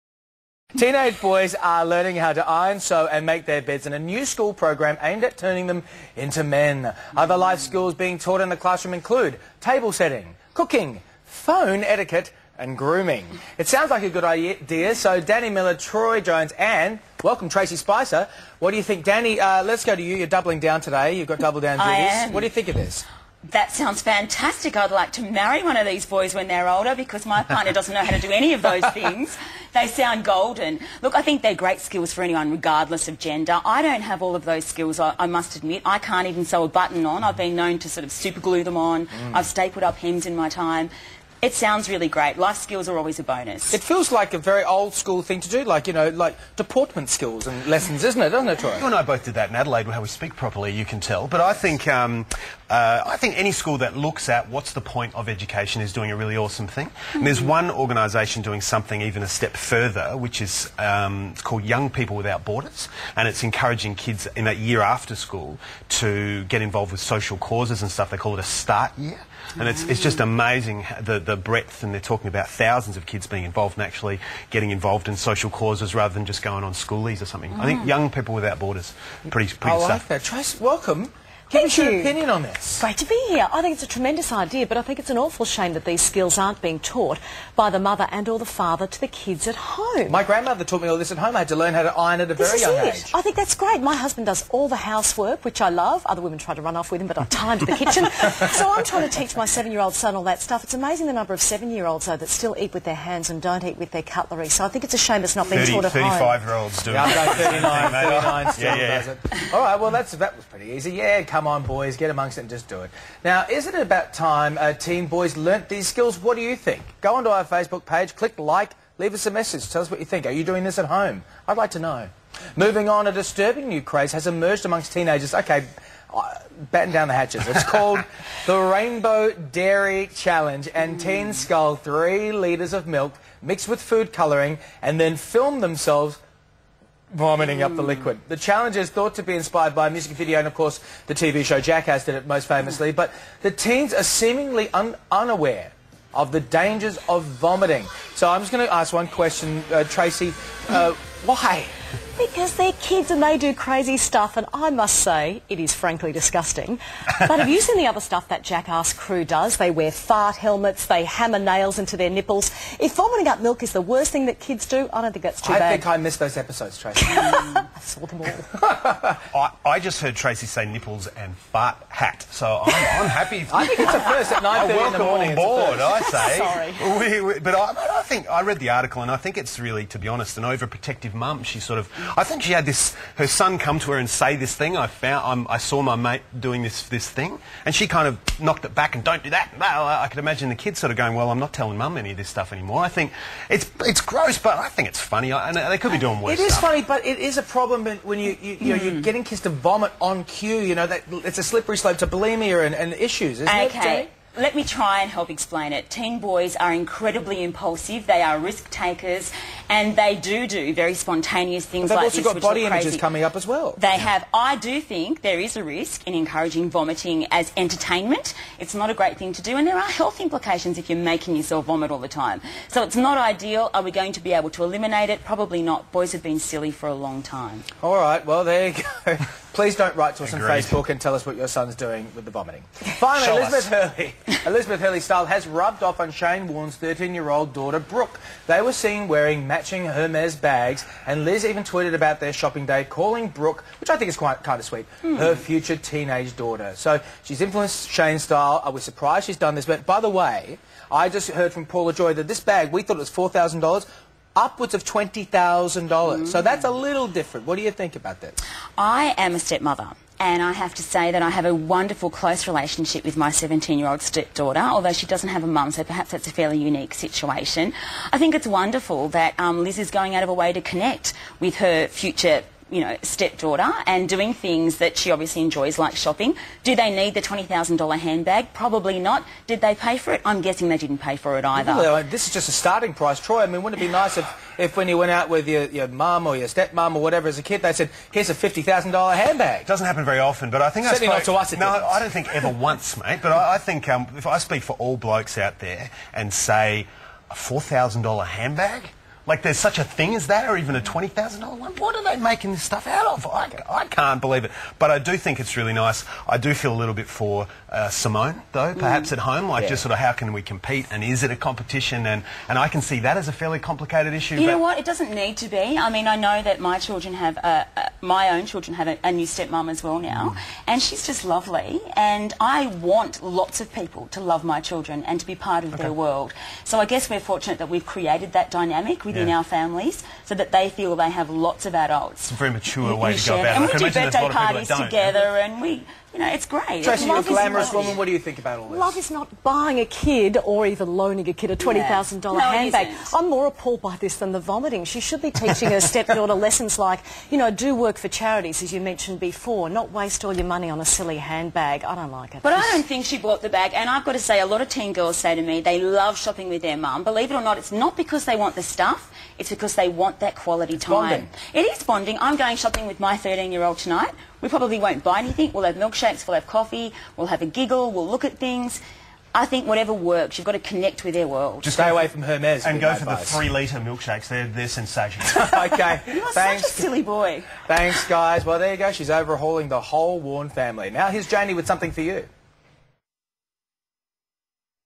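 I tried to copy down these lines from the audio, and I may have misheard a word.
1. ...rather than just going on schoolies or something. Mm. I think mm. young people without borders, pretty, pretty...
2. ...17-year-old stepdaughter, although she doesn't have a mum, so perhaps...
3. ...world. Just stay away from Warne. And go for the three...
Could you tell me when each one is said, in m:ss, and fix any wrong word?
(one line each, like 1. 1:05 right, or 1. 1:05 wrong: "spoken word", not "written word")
1. 1:15 right
2. 4:23 right
3. 6:11 wrong: "Hermes", not "Warne".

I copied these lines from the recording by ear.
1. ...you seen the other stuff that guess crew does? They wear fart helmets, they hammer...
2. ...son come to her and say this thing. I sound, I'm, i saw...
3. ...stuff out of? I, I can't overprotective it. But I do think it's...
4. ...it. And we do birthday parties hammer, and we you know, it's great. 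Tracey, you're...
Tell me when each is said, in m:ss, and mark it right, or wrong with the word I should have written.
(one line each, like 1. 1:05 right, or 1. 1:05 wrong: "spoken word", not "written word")
1. 2:37 wrong: "jackass", not "guess"
2. 3:03 wrong: "found", not "sound"
3. 5:02 wrong: "believe", not "overprotective"
4. 5:33 wrong: "together", not "hammer".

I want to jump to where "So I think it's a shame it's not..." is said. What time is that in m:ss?
1:44.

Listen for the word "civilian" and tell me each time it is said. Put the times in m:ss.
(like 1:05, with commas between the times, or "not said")
not said.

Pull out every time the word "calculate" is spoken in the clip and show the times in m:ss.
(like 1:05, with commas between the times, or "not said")
not said.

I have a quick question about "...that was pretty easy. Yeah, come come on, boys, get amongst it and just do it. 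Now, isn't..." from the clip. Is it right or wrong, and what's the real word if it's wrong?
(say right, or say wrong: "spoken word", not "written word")
right.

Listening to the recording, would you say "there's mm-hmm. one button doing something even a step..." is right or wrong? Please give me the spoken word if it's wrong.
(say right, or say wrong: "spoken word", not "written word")
wrong: "organisation", not "button".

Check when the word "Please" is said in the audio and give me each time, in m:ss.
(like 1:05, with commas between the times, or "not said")
3:49.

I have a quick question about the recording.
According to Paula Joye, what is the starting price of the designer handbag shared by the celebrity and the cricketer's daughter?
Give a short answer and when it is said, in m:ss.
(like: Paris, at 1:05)
$20,000, at 4:14.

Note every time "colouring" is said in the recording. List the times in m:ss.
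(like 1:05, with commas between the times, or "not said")
2:14.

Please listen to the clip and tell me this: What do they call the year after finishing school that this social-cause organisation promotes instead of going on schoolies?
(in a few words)
Start year.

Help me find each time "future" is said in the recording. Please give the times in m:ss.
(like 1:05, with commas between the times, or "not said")
4:05, 4:31.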